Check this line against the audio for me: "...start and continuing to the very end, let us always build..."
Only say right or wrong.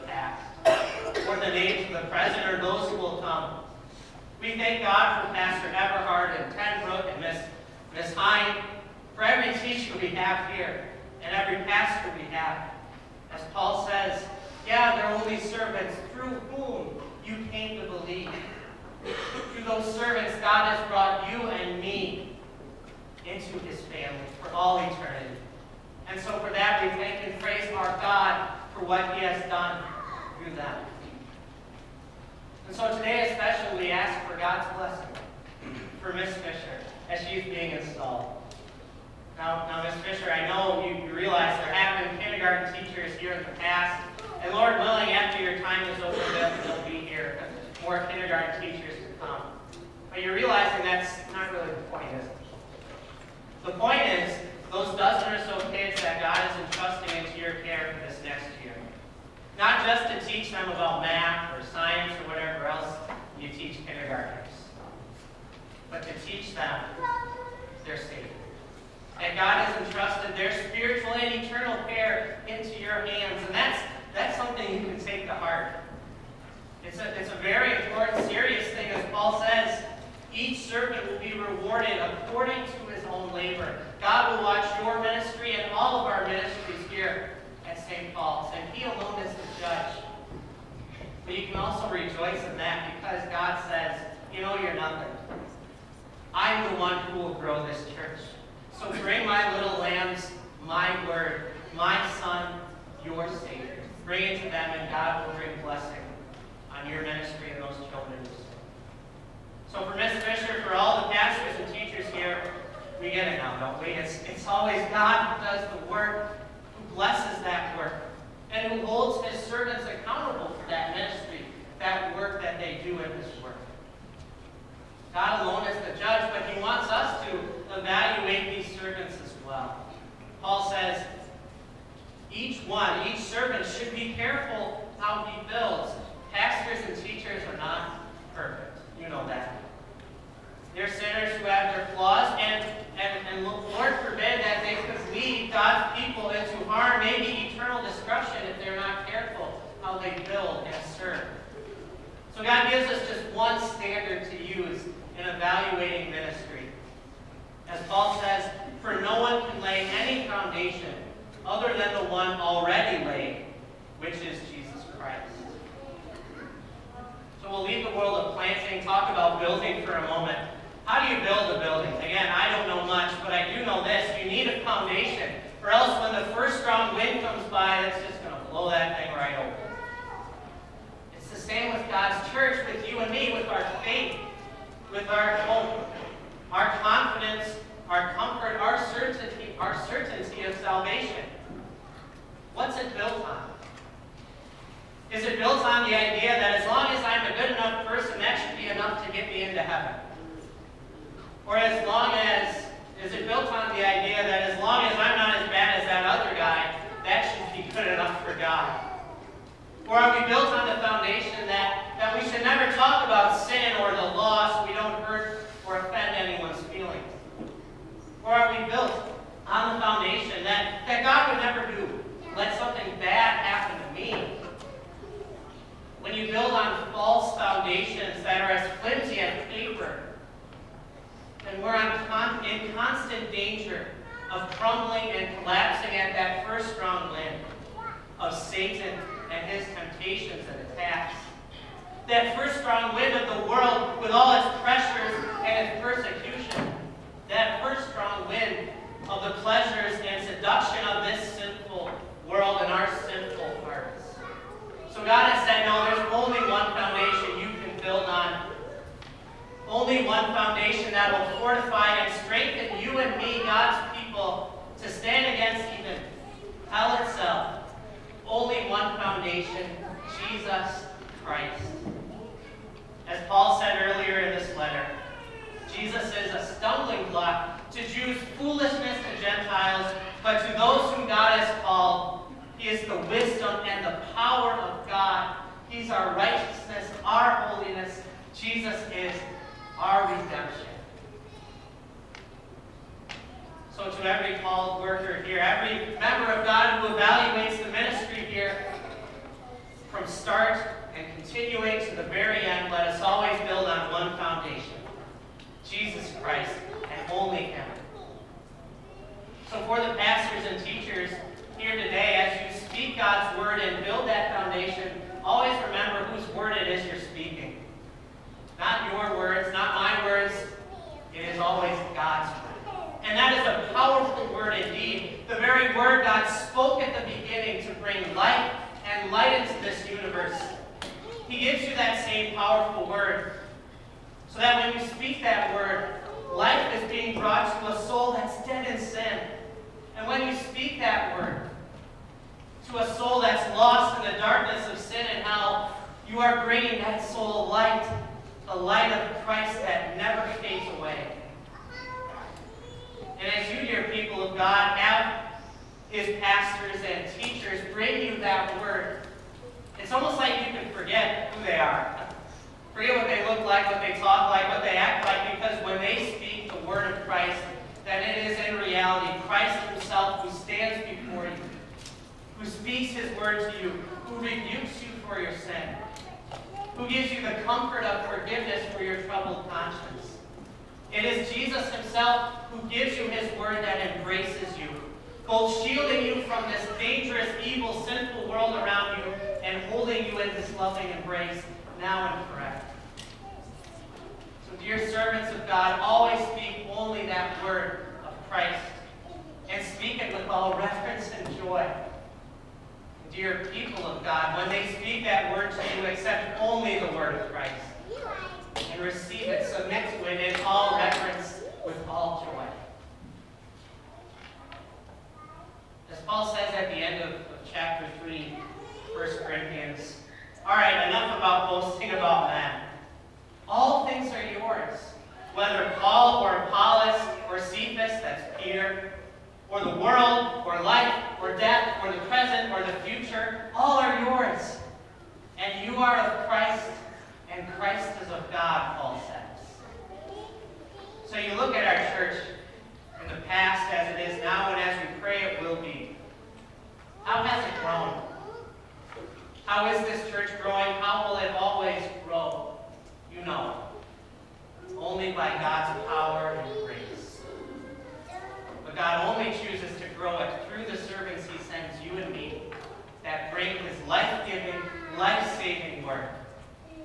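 right.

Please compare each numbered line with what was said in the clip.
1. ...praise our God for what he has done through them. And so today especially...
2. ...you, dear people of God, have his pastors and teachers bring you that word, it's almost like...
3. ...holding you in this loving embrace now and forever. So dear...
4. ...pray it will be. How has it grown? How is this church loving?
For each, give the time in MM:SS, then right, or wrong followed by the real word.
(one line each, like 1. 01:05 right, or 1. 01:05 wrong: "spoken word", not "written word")
1. 00:27 right
2. 05:53 right
3. 06:29 right
4. 07:25 wrong: "growing", not "loving".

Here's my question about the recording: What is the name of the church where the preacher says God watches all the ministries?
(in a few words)
St. Paul's.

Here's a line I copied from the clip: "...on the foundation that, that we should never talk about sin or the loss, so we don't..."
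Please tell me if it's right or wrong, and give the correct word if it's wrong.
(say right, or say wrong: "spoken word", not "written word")
right.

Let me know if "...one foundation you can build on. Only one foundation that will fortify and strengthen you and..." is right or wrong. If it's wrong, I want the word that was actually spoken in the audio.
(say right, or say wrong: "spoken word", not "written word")
right.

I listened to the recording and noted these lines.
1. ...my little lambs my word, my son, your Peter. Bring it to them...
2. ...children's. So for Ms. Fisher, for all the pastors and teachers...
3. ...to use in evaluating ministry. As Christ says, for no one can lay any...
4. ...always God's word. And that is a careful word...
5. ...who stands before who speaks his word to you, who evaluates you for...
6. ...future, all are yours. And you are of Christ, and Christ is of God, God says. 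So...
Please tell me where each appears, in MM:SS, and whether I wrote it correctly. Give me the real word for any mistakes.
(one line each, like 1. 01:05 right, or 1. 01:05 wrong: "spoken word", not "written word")
1. 01:39 wrong: "Savior", not "Peter"
2. 01:47 right
3. 02:34 wrong: "Paul", not "Christ"
4. 05:21 wrong: "powerful", not "careful"
5. 06:10 wrong: "rebukes", not "evaluates"
6. 07:12 wrong: "Paul", not "God".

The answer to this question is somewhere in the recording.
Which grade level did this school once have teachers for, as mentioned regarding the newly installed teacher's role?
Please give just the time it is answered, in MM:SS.
00:42.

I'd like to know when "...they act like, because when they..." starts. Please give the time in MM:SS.
06:04.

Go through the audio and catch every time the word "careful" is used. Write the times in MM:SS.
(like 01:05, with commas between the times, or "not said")
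02:14, 02:29.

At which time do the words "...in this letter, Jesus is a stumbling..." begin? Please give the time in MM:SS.
04:34.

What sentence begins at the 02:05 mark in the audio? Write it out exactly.
God alone is the judge, but he wants us to evaluate these servants as well.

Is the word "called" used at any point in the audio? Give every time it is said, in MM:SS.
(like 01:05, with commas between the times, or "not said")
04:41, 04:54.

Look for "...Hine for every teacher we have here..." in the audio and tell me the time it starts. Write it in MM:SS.
00:08.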